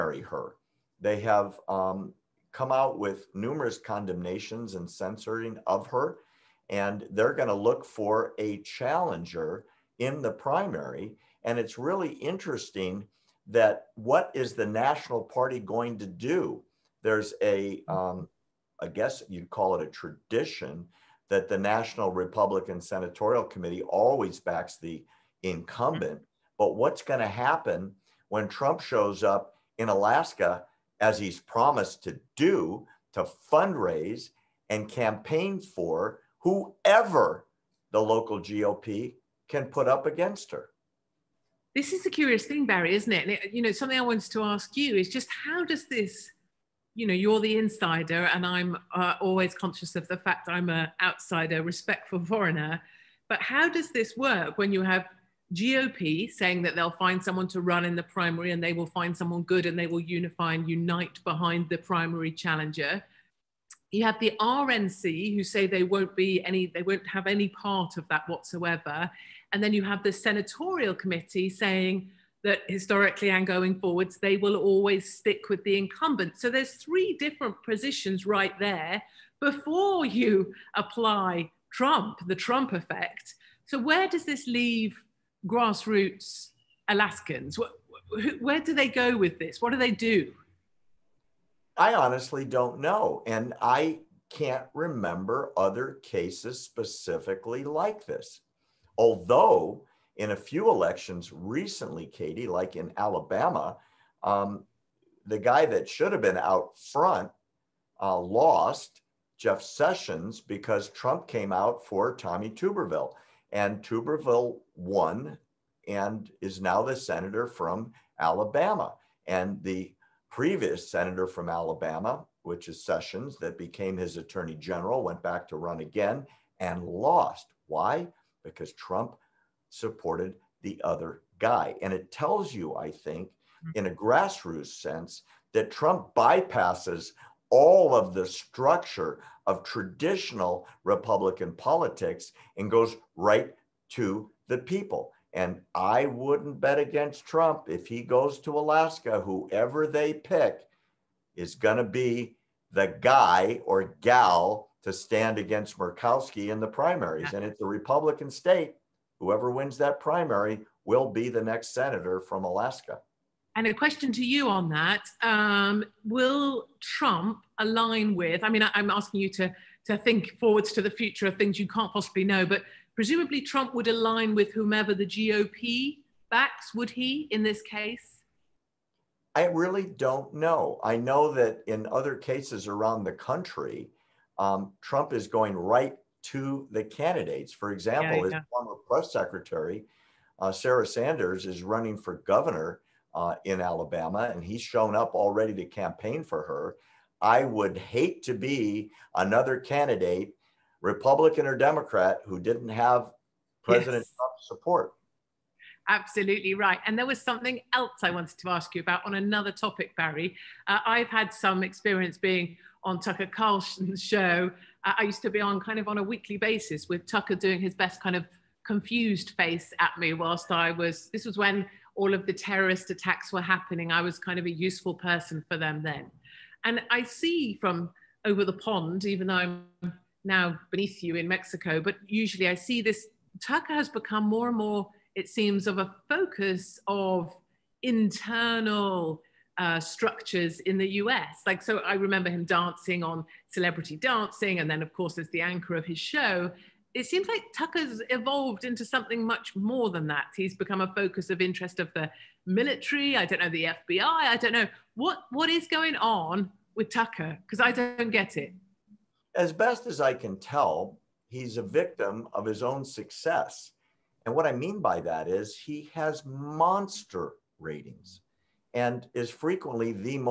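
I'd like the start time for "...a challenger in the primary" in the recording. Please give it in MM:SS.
00:08.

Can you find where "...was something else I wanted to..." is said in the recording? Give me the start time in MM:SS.
03:27.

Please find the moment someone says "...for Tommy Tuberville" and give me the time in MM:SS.
01:51.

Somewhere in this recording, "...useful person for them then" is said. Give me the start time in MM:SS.
03:44.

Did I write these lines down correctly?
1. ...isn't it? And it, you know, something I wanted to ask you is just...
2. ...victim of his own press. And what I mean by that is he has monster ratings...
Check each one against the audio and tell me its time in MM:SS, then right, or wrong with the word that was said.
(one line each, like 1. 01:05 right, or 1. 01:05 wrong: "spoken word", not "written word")
1. 00:42 right
2. 04:21 wrong: "success", not "press".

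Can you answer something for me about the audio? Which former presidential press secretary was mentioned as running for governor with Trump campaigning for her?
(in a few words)
Sarah Sanders.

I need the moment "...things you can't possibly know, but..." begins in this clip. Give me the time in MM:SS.
02:51.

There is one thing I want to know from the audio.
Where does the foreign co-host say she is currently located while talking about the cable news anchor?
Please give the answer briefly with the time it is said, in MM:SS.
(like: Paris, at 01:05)
Mexico, at 03:51.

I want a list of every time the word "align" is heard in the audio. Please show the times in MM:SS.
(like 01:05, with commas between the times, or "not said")
02:47, 02:53.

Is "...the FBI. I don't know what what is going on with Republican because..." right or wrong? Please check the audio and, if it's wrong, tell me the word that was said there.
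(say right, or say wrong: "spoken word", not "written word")
wrong: "Tucker", not "Republican".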